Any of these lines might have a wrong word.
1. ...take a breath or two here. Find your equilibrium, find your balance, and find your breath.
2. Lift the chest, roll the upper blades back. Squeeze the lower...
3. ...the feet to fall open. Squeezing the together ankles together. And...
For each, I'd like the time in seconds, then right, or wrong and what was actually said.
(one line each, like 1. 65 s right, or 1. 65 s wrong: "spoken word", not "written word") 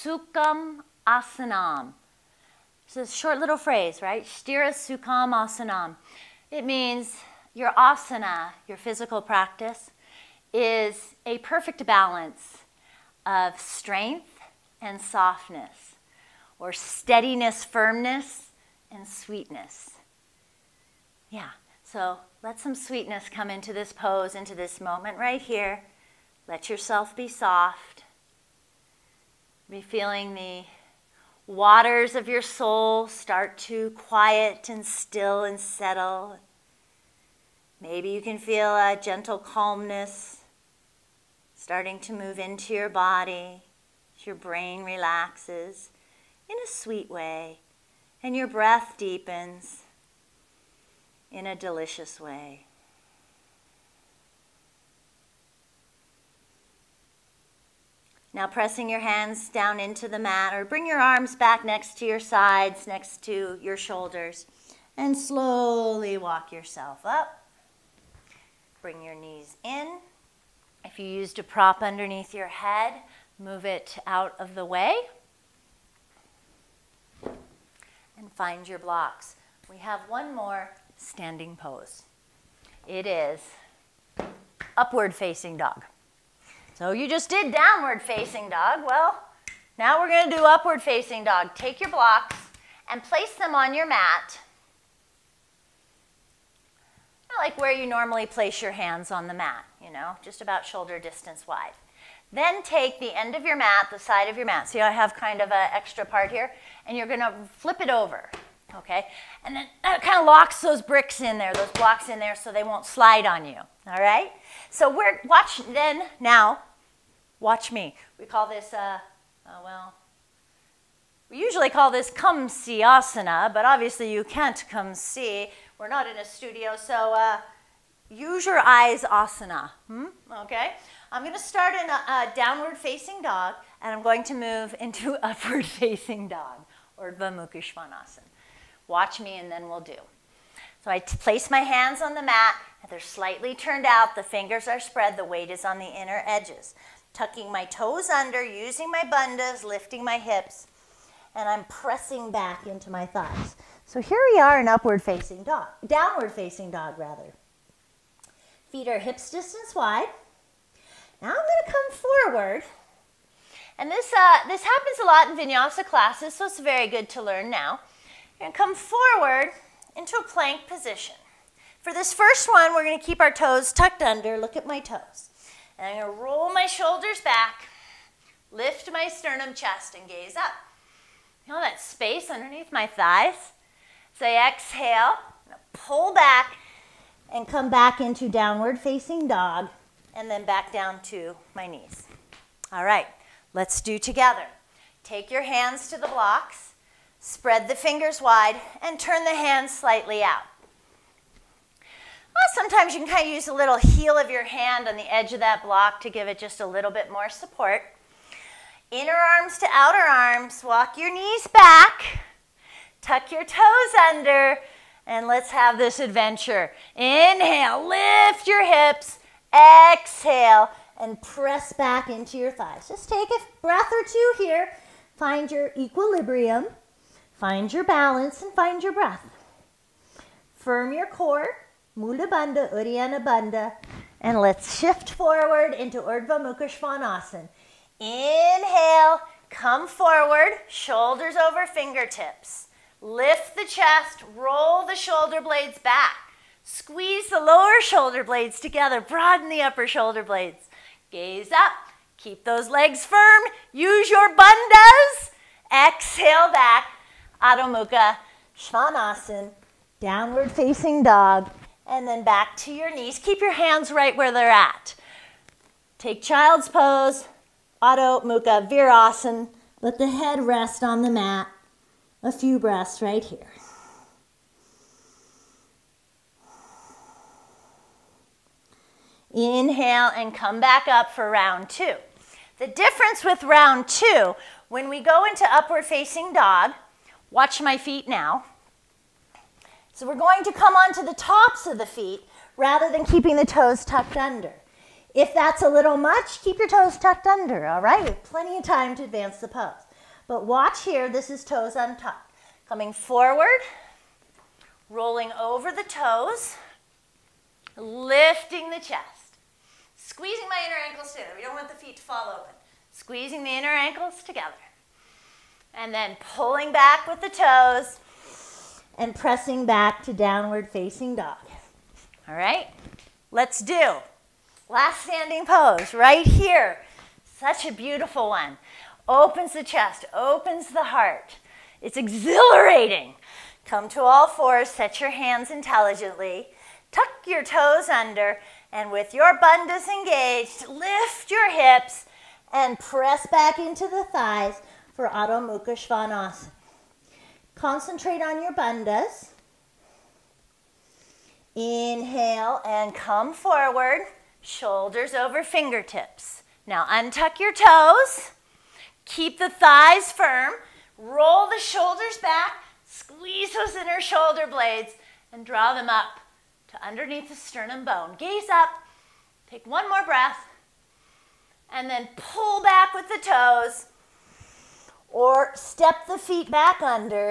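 1. 223 s right
2. 243 s wrong: "shoulder", not "upper"
3. 311 s wrong: "inner", not "together".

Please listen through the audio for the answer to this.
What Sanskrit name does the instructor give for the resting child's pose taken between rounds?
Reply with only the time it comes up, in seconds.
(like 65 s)
267 s.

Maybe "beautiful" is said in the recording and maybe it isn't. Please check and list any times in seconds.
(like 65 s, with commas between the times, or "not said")
327 s.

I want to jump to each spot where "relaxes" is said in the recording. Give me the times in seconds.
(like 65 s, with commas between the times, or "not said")
44 s.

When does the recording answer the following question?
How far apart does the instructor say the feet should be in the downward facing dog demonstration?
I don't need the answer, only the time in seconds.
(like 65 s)
159 s.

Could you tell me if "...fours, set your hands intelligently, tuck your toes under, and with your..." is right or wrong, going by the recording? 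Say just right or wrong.
right.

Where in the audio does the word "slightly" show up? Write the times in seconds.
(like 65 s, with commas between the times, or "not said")
142 s, 199 s.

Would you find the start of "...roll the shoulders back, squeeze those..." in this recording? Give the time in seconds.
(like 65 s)
360 s.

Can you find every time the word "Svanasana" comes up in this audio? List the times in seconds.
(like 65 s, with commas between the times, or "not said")
236 s, 258 s, 345 s.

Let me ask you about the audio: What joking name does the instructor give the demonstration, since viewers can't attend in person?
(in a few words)
use your eyes asana.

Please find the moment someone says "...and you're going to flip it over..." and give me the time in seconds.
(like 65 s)
106 s.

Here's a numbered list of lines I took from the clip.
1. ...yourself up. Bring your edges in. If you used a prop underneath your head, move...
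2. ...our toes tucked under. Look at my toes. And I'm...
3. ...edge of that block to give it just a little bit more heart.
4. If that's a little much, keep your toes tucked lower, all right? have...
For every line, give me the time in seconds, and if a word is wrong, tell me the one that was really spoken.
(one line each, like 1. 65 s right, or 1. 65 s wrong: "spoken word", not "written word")
1. 66 s wrong: "knees", not "edges"
2. 173 s right
3. 205 s wrong: "support", not "heart"
4. 295 s wrong: "under", not "lower".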